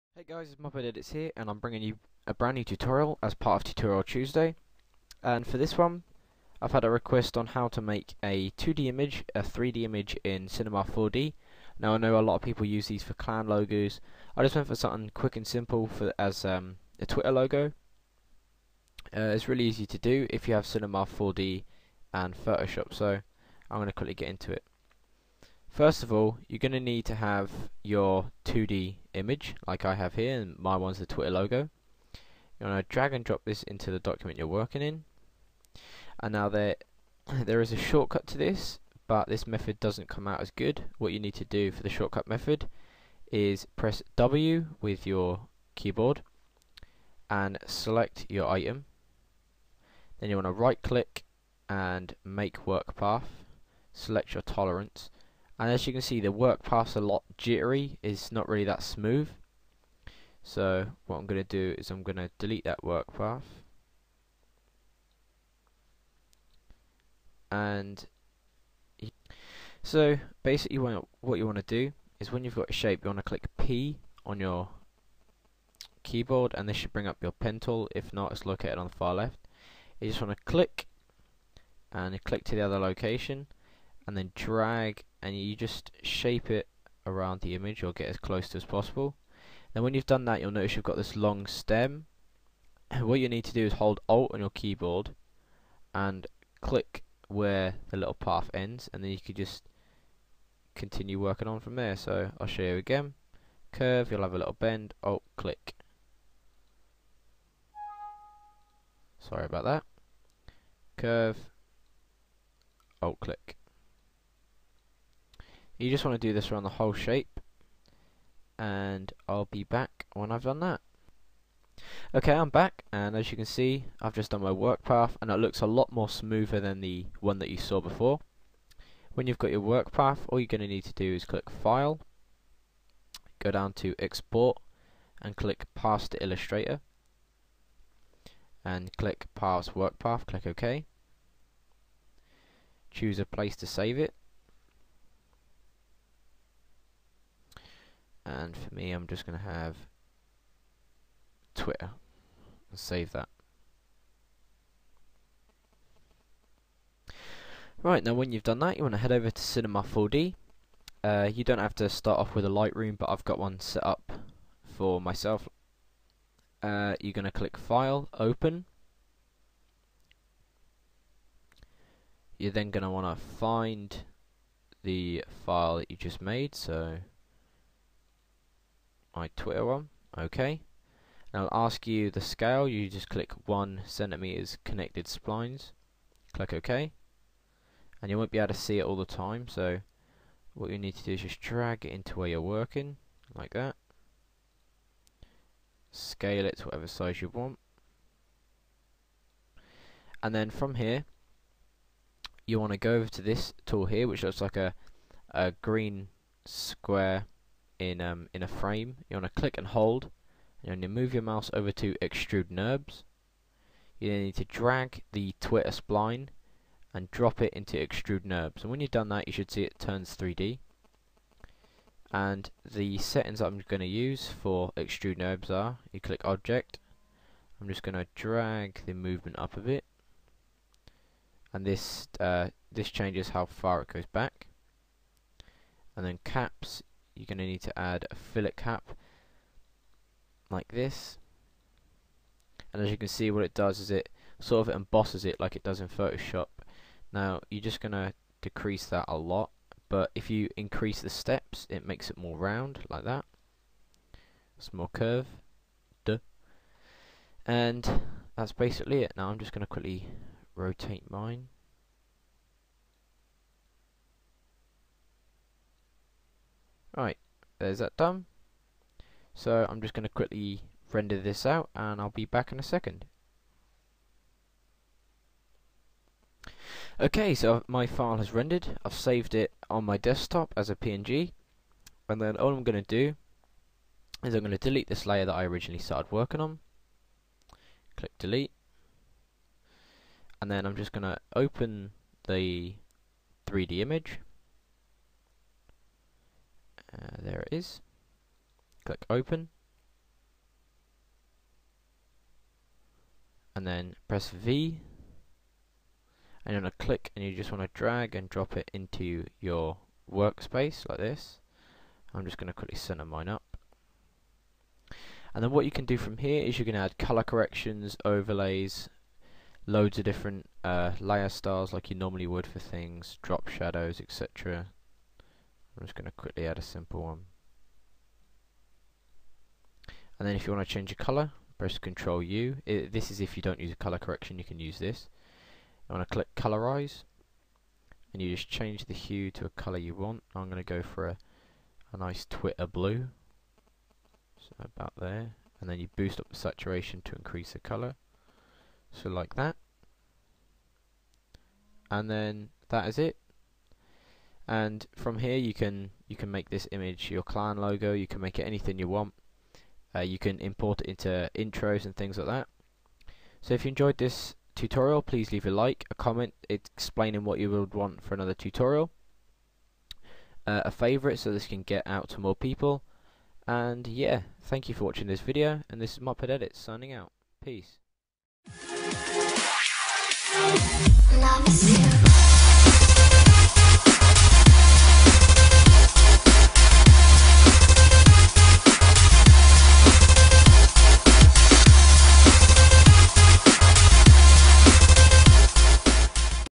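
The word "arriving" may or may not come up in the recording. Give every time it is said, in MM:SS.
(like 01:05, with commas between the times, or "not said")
not said.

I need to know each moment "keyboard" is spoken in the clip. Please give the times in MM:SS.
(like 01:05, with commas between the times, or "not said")
00:45, 01:16, 01:34.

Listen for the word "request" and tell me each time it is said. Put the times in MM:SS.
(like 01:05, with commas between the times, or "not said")
00:06.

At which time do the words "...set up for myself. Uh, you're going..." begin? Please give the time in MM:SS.
02:43.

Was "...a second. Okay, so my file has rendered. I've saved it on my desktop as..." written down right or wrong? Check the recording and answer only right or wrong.
right.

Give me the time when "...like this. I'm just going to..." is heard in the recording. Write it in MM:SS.
05:10.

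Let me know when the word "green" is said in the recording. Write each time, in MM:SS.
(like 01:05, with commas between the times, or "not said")
03:25.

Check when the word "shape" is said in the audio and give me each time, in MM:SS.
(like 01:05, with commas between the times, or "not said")
01:12, 01:26, 01:56.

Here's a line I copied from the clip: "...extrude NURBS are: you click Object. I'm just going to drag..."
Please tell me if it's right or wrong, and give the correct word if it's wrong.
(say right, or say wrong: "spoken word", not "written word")
right.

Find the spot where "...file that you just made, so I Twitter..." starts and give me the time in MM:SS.
02:55.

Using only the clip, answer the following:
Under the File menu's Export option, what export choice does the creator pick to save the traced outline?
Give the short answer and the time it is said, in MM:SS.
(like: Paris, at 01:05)
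Paths to Illustrator, at 02:15.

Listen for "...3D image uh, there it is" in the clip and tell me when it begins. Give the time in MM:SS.
04:53.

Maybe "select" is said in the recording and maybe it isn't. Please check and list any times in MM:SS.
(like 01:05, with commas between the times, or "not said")
00:47, 00:53.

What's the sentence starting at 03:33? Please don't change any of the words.
You then need to drag the Twitter spline and drop it into extrude NURBS.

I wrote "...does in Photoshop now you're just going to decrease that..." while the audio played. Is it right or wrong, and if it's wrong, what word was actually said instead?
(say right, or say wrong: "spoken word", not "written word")
right.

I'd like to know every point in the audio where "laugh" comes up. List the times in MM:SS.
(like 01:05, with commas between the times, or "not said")
not said.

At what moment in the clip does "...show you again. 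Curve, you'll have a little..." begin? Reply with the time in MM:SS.
01:42.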